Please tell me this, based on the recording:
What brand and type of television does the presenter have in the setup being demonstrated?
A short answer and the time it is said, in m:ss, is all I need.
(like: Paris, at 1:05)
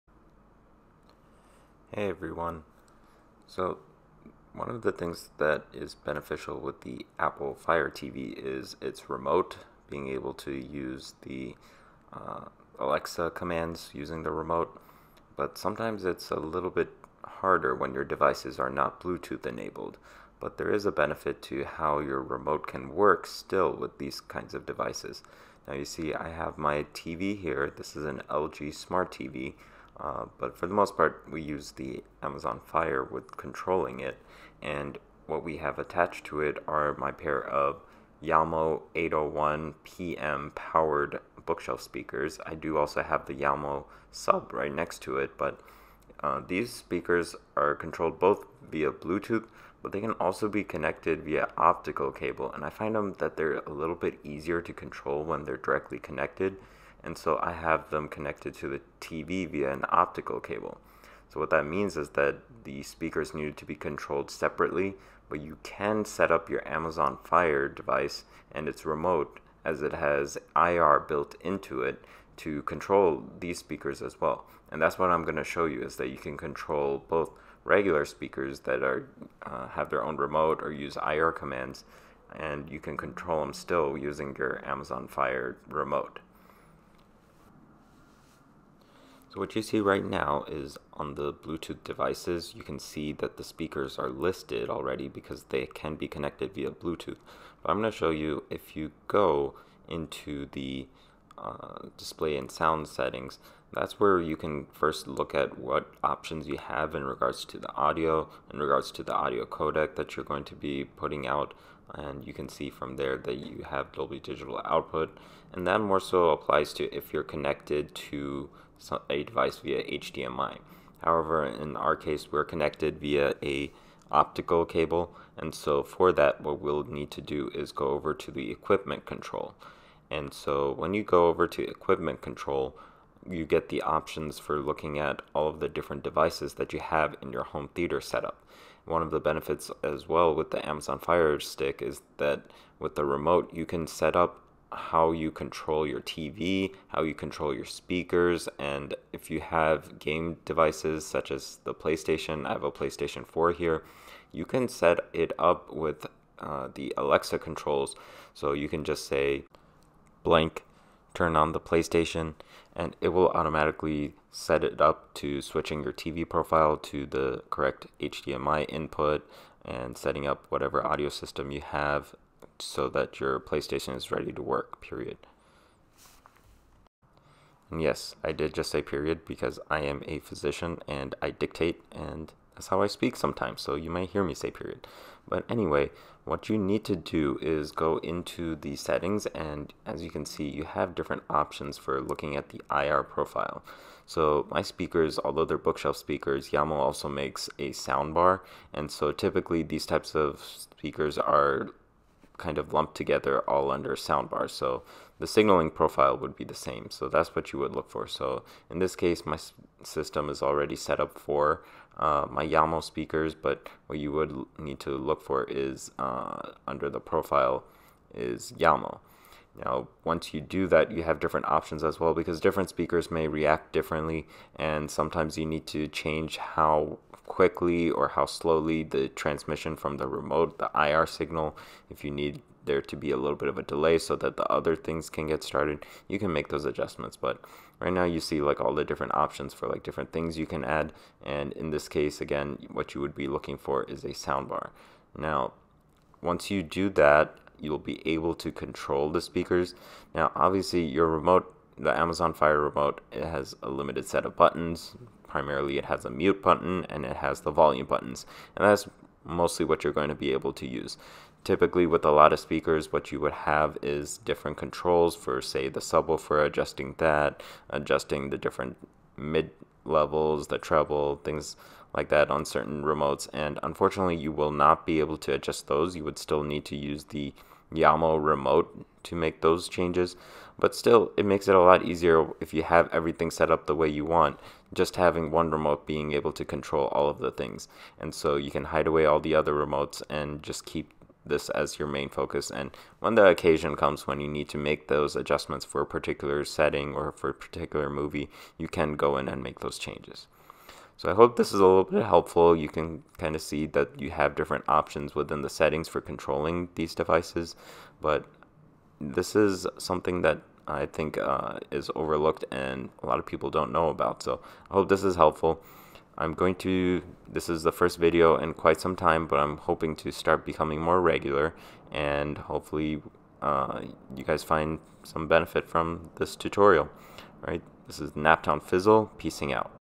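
LG Smart TV, at 0:28.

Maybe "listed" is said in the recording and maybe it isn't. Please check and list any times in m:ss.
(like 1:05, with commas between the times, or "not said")
1:34.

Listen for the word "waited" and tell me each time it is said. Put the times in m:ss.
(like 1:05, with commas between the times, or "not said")
not said.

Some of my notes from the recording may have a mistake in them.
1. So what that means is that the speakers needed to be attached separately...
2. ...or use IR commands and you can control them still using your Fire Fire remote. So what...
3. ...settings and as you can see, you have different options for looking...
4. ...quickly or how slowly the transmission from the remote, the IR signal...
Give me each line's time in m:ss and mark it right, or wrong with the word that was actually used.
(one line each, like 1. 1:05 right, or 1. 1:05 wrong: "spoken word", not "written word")
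1. 1:01 wrong: "controlled", not "attached"
2. 1:20 wrong: "Amazon", not "Fire"
3. 3:08 right
4. 3:47 right.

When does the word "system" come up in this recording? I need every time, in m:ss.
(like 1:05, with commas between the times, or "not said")
2:51, 3:29.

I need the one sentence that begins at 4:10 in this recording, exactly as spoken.
Now, obviously, your remote, the Amazon Fire remote, it has a limited set of buttons.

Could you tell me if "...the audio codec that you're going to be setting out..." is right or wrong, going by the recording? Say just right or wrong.
wrong.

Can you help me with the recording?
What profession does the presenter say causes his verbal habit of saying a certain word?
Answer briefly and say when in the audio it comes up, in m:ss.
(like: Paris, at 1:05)
physician, at 3:00.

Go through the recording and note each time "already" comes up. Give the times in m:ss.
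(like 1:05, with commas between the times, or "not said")
1:34, 3:30.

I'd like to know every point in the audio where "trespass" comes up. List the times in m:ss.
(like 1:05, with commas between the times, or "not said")
not said.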